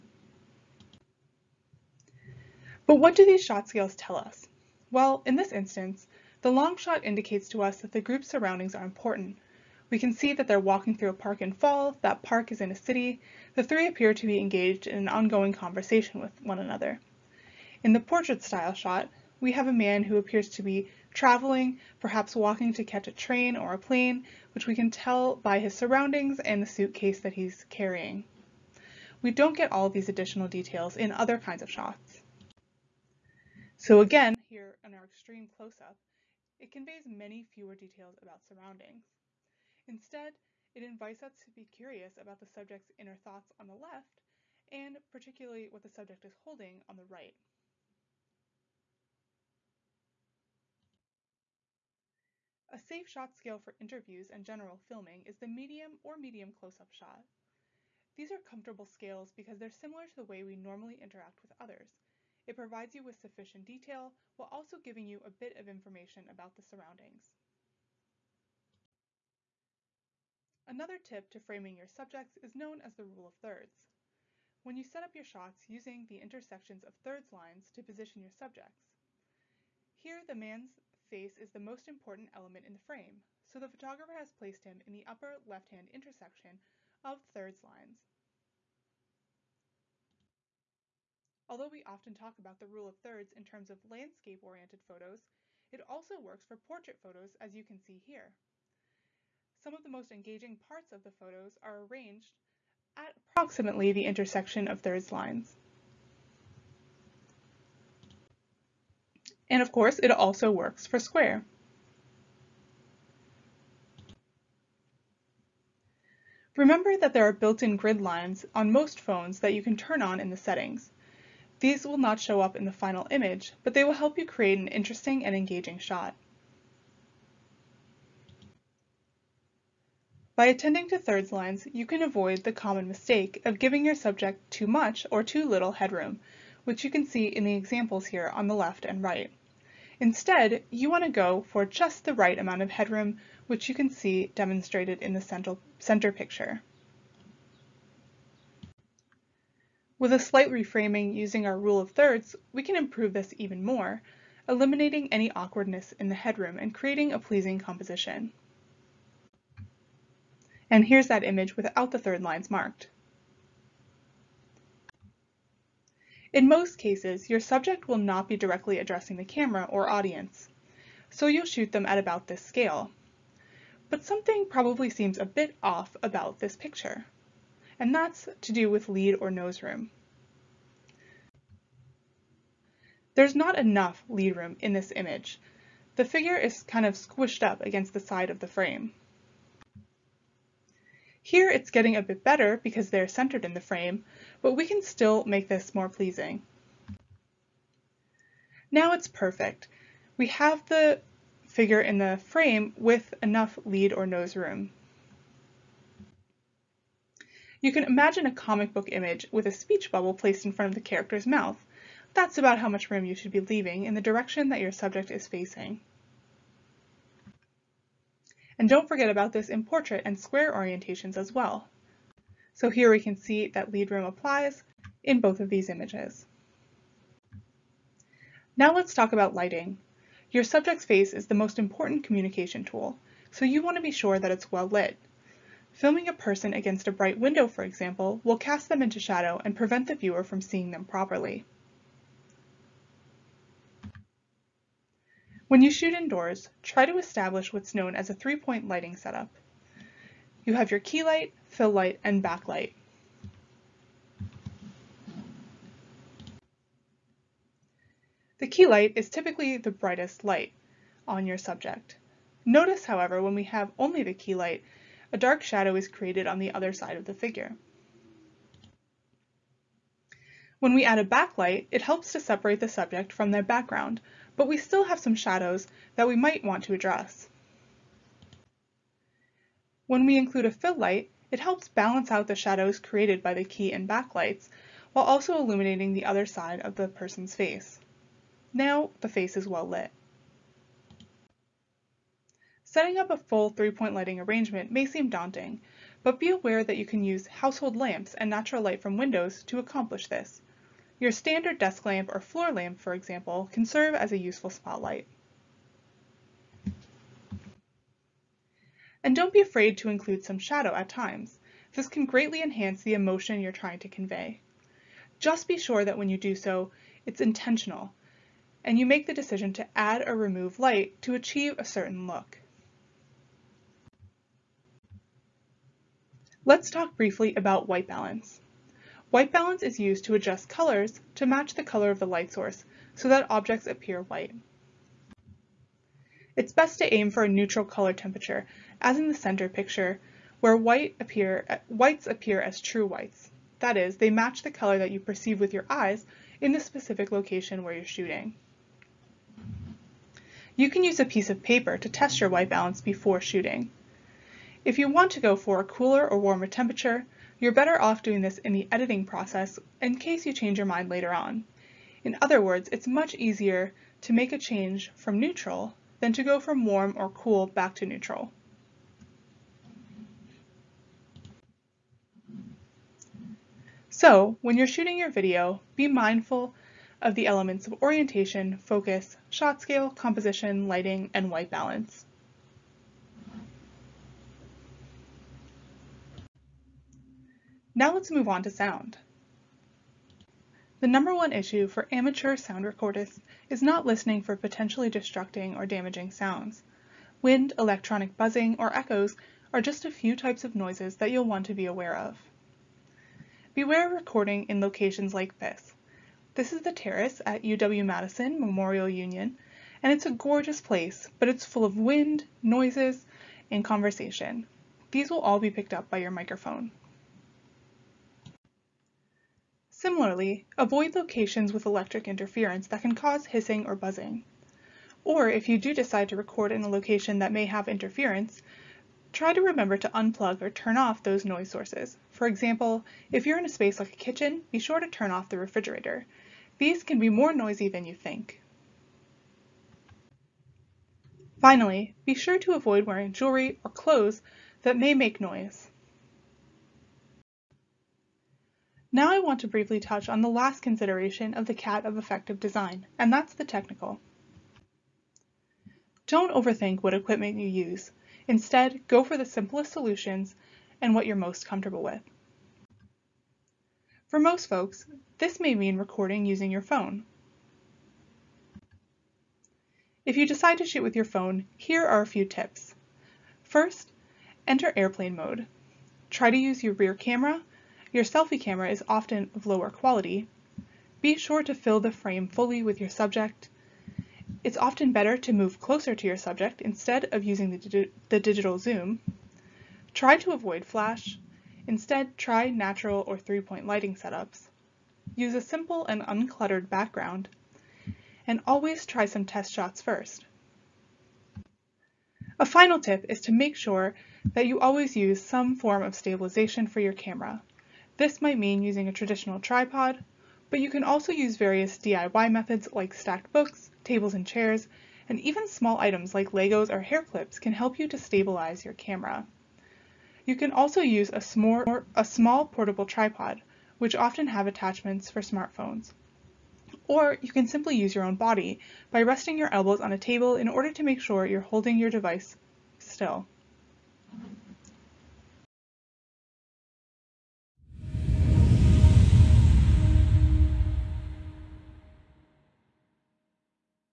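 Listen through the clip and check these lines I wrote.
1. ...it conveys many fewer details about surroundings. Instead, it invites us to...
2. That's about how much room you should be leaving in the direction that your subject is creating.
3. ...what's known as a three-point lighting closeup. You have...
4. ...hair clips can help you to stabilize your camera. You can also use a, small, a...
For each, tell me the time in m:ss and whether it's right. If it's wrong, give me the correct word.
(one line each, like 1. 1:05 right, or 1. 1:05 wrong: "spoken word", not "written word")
1. 0:36 right
2. 3:32 wrong: "facing", not "creating"
3. 4:07 wrong: "setup", not "closeup"
4. 8:36 right.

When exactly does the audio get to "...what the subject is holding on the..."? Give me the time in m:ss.
0:45.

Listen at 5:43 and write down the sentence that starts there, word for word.
That is, they match the color that you perceive with your eyes in the specific location where you're shooting.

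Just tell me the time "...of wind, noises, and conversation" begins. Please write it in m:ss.
6:51.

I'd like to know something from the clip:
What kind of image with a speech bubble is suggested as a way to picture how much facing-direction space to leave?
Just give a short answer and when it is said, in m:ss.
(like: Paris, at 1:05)
comic book, at 3:28.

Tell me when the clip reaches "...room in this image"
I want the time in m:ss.
3:04.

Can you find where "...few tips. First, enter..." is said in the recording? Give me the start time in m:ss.
7:52.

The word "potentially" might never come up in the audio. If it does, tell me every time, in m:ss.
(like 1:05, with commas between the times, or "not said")
6:34.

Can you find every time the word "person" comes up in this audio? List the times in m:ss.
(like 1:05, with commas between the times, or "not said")
3:56, 4:46.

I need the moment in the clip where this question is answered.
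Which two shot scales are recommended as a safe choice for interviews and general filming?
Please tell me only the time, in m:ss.
0:55.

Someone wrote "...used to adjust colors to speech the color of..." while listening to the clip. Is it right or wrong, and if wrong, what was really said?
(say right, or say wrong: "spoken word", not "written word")
wrong: "match", not "speech".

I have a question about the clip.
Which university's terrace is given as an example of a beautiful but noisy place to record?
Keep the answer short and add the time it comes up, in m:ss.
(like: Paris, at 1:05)
UW-Madison, at 6:47.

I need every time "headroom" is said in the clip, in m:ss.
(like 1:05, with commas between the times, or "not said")
2:15, 2:22, 2:36.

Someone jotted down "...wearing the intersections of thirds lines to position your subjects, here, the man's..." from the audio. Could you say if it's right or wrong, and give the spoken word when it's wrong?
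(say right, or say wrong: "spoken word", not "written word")
wrong: "using", not "wearing".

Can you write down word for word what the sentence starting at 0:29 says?
We don't get all these additional details in other kinds of shots.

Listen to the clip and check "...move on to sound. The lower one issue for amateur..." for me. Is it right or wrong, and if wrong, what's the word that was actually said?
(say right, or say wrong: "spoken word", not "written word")
wrong: "number", not "lower".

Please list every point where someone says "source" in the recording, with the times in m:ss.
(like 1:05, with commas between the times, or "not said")
5:32, 7:11.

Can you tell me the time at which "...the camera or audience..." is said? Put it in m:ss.
2:49.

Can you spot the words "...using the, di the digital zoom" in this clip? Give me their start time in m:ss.
8:07.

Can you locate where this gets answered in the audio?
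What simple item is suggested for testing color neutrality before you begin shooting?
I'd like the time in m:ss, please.
5:51.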